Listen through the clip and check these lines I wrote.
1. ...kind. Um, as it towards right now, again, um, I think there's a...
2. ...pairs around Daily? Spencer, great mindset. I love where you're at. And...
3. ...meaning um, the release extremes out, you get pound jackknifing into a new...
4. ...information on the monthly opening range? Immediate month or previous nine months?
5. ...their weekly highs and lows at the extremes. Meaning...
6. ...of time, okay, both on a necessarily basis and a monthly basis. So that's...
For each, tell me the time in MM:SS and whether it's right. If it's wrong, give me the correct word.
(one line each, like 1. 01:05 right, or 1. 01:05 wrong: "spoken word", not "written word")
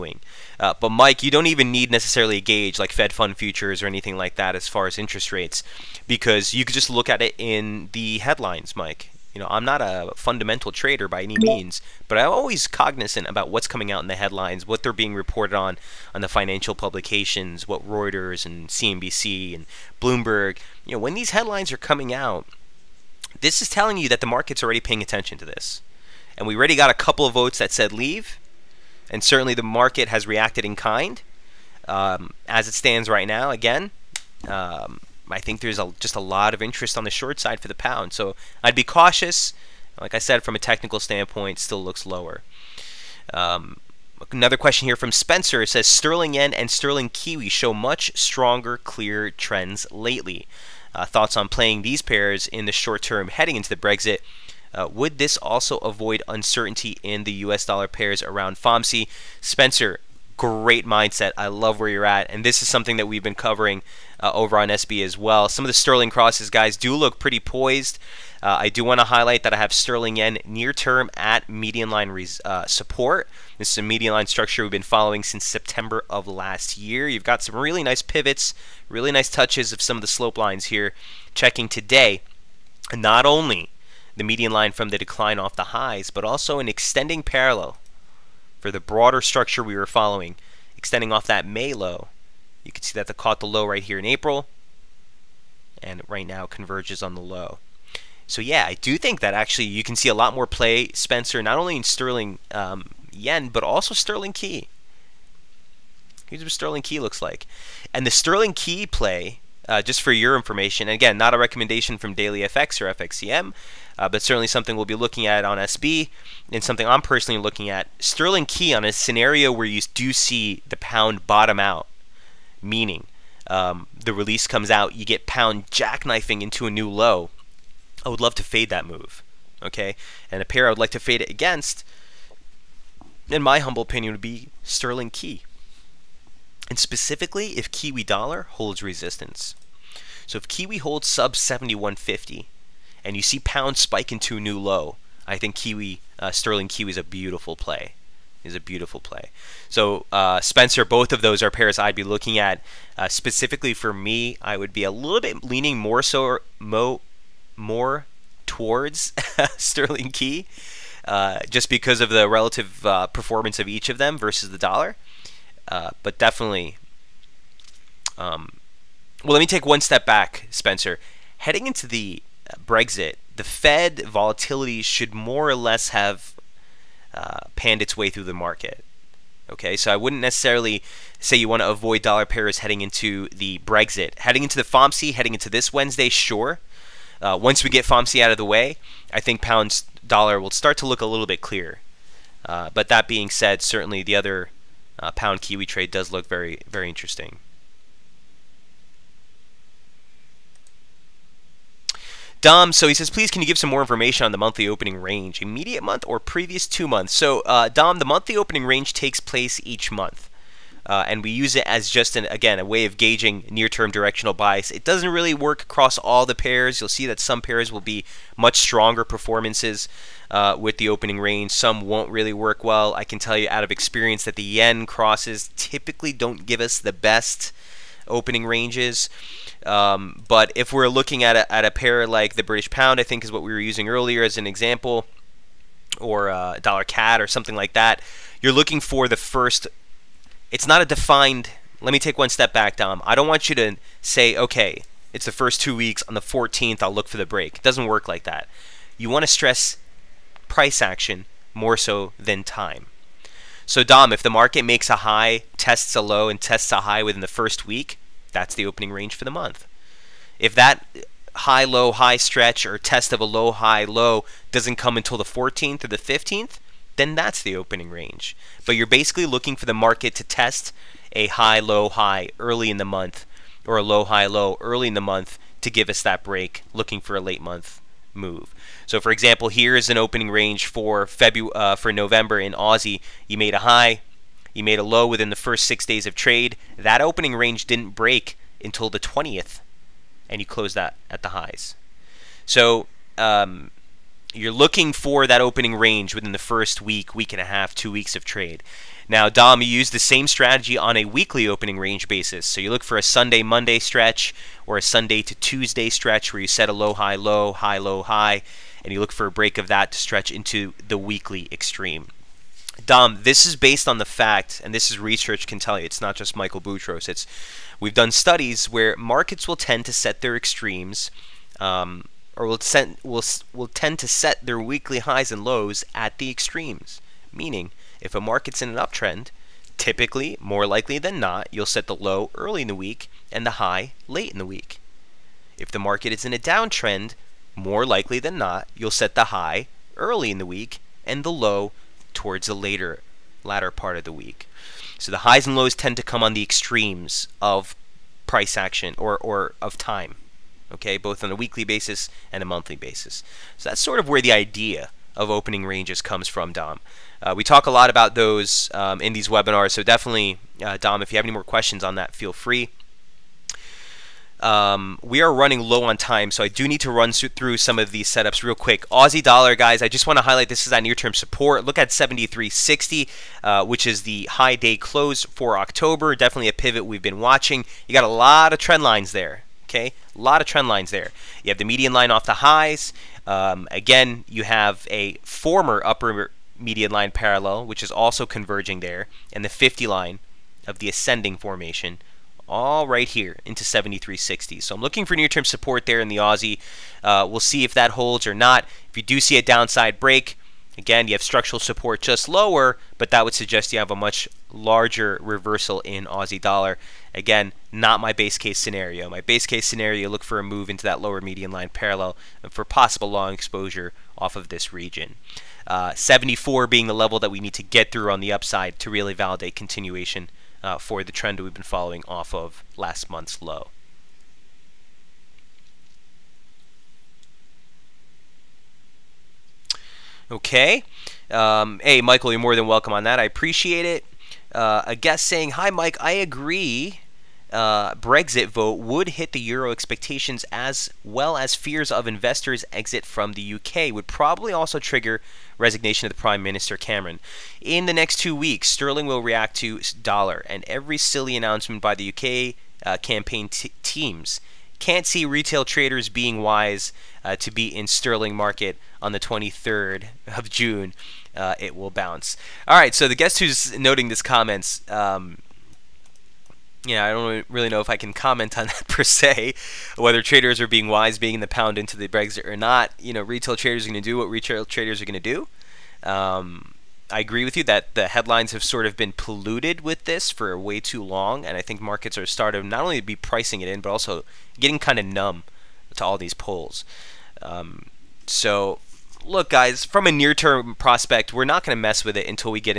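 1. 00:30 wrong: "stands", not "towards"
2. 00:57 wrong: "FOMC", not "Daily"
3. 02:02 wrong: "comes", not "extremes"
4. 03:23 wrong: "two", not "nine"
5. 05:24 right
6. 05:49 wrong: "weekly", not "necessarily".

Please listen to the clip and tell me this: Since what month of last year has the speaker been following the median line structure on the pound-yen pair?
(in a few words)
September.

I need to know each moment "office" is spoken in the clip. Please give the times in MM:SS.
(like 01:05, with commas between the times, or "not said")
not said.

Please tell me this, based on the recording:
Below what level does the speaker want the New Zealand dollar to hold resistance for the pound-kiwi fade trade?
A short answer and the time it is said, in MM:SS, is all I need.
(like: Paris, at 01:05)
7150, at 02:21.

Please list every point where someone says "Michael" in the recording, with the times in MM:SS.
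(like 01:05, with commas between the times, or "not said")
05:16, 07:12.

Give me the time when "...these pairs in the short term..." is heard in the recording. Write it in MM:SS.
00:51.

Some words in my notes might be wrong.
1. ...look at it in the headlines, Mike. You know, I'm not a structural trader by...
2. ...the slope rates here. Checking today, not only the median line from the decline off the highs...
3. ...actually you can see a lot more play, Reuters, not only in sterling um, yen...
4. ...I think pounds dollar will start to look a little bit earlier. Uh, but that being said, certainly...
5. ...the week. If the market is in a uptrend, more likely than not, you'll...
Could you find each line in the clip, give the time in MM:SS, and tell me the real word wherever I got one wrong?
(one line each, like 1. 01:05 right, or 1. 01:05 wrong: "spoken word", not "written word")
1. 00:06 wrong: "fundamental", not "structural"
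2. 01:20 wrong: "lines", not "rates"
3. 01:39 wrong: "Spencer", not "Reuters"
4. 03:09 wrong: "clearer", not "earlier"
5. 05:34 wrong: "downtrend", not "uptrend".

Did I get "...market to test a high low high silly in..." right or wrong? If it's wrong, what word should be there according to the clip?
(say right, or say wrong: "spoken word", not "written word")
wrong: "early", not "silly".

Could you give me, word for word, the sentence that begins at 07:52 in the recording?
You know, retail traders are going to do what retail traders are going to do.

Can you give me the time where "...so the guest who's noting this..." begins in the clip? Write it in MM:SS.
07:42.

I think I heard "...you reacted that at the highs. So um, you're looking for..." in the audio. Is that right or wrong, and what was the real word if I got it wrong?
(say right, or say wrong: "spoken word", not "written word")
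wrong: "closed", not "reacted".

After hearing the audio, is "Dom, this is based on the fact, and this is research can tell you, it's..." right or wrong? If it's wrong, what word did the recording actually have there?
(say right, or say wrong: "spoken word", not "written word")
right.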